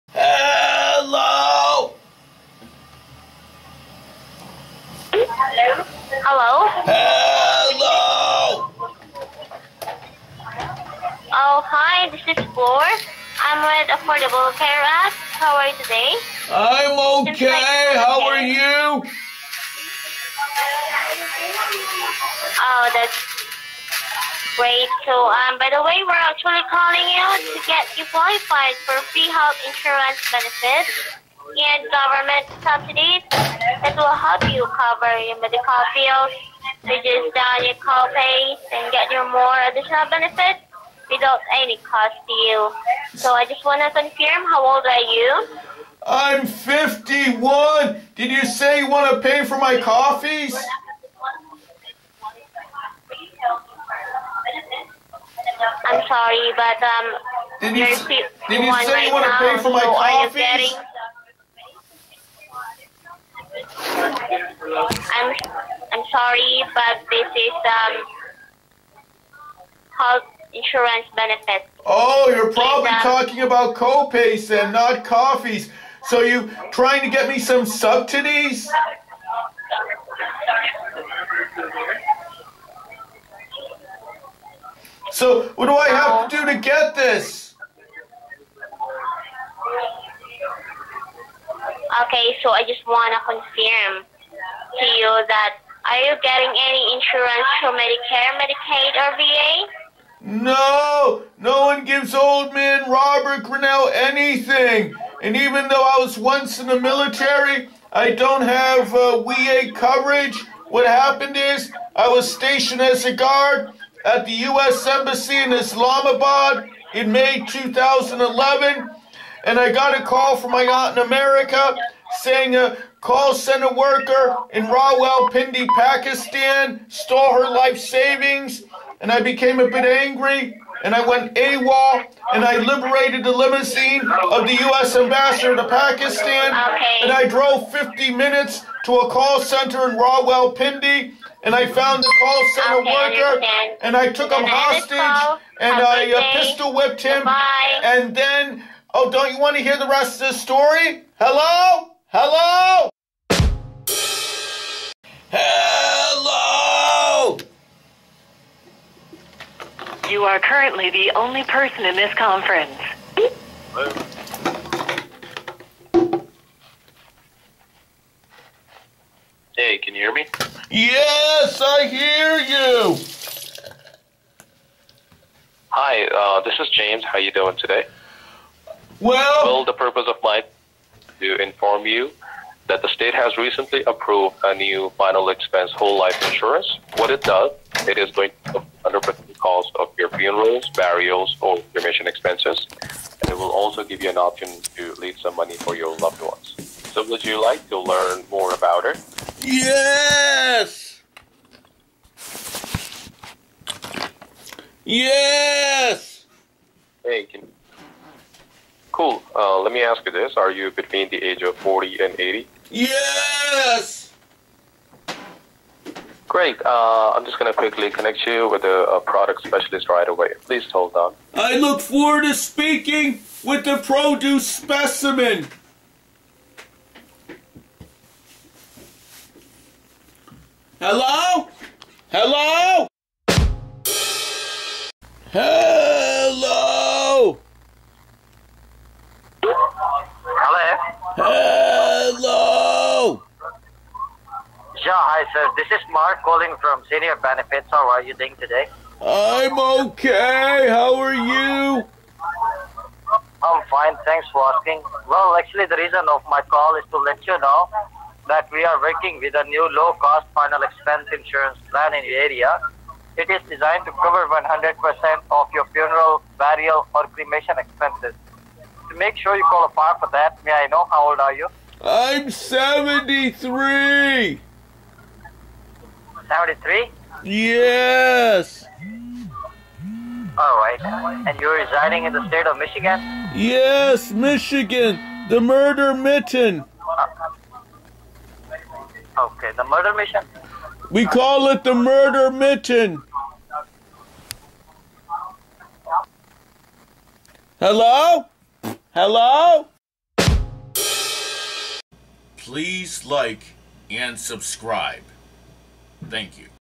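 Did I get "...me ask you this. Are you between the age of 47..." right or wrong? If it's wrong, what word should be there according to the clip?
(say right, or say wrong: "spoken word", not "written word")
wrong: "40", not "47".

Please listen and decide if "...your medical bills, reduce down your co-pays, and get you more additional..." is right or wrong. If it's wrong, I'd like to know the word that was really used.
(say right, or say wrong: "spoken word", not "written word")
right.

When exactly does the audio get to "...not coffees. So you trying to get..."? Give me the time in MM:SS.
01:14.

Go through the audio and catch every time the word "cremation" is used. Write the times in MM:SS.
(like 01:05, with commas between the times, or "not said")
03:11, 04:27.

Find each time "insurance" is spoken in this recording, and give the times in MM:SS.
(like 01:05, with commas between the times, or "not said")
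00:29, 01:10, 01:36, 03:06, 04:21.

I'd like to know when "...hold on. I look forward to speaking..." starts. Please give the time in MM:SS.
03:40.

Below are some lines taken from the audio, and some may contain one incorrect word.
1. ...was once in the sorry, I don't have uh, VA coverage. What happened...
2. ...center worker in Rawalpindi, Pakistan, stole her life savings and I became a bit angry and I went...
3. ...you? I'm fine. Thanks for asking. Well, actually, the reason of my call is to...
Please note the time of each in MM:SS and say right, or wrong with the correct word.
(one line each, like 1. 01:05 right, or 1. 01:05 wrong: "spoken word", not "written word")
1. 01:45 wrong: "military", not "sorry"
2. 02:03 right
3. 04:11 right.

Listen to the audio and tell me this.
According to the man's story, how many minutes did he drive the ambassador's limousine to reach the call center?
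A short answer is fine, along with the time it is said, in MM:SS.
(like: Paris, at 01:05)
50, at 02:17.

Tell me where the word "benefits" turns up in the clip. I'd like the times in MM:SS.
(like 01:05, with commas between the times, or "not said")
00:30, 00:40, 01:11, 04:07.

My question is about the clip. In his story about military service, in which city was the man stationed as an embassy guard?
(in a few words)
Islamabad.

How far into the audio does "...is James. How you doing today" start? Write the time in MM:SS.
02:56.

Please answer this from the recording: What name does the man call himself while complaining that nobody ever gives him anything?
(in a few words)
Robert Grinnell.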